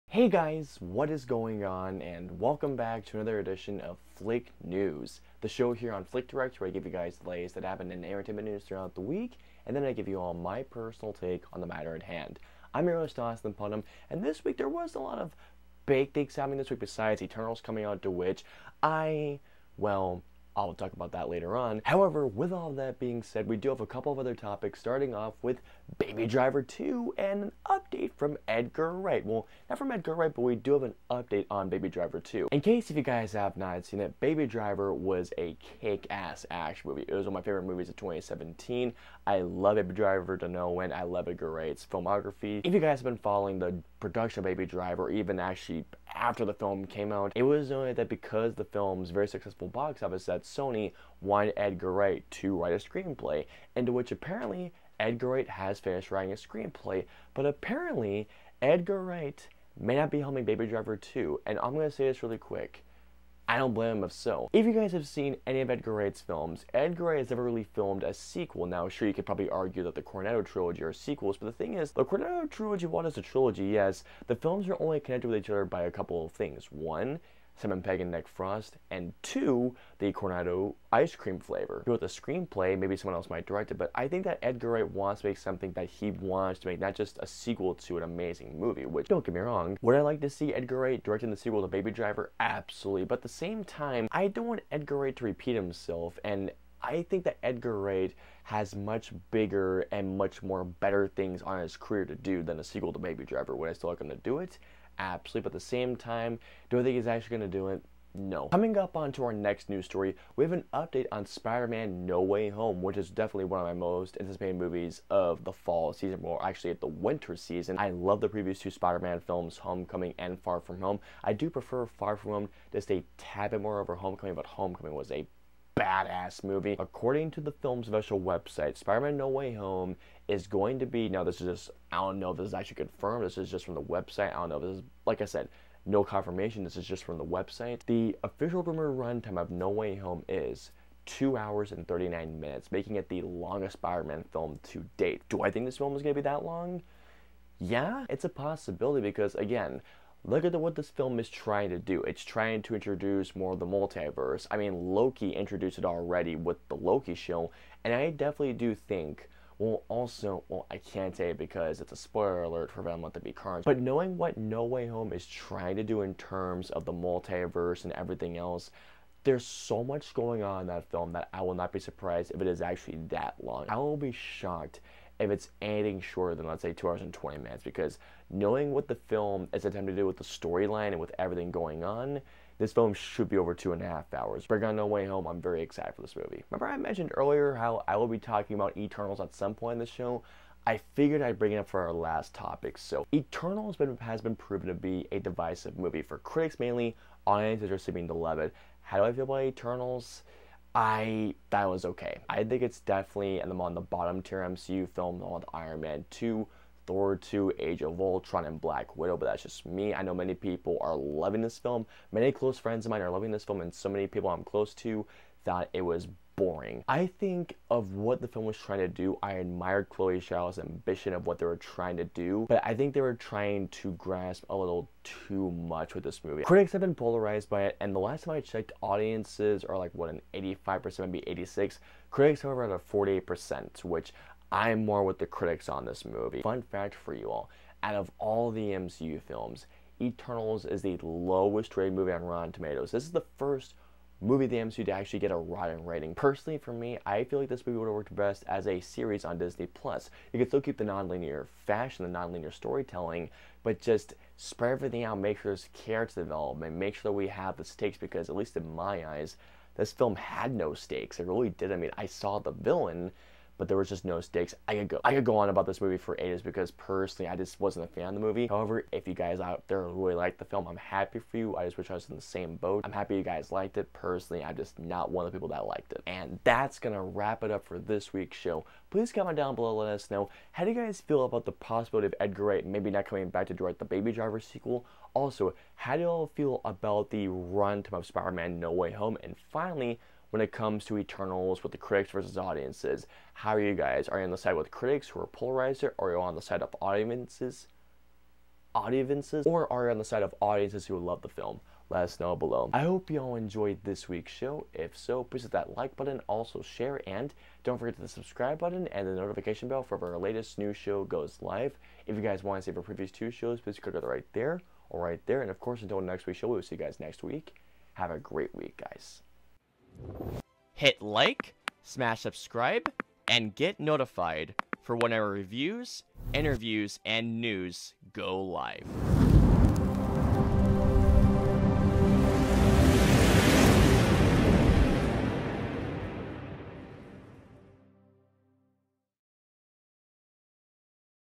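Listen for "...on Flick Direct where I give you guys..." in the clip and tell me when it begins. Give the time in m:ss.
0:05.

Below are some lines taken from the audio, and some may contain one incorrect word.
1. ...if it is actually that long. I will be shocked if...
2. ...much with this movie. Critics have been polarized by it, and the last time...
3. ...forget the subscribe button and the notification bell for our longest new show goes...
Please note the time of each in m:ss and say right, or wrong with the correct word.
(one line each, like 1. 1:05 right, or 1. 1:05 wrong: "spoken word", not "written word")
1. 2:52 right
2. 3:45 right
3. 5:07 wrong: "latest", not "longest".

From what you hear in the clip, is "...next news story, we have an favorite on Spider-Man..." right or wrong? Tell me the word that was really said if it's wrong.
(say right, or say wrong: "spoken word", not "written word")
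wrong: "update", not "favorite".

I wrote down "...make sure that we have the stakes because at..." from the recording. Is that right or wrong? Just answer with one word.
right.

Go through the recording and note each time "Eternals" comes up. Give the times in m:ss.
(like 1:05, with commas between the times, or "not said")
0:17, 3:08, 3:13, 3:19, 4:00, 4:50.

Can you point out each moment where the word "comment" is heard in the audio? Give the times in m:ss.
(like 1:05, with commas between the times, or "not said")
4:39.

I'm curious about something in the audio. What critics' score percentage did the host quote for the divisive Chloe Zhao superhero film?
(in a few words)
48%.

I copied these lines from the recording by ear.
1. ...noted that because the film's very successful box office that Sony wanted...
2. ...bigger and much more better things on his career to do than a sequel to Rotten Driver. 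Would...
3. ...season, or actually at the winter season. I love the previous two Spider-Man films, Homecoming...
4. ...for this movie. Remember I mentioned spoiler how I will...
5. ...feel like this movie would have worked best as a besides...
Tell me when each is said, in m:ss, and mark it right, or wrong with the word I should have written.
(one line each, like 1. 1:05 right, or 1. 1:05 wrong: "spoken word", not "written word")
1. 0:47 right
2. 1:39 wrong: "Baby", not "Rotten"
3. 1:55 right
4. 3:05 wrong: "earlier", not "spoiler"
5. 4:07 wrong: "series", not "besides".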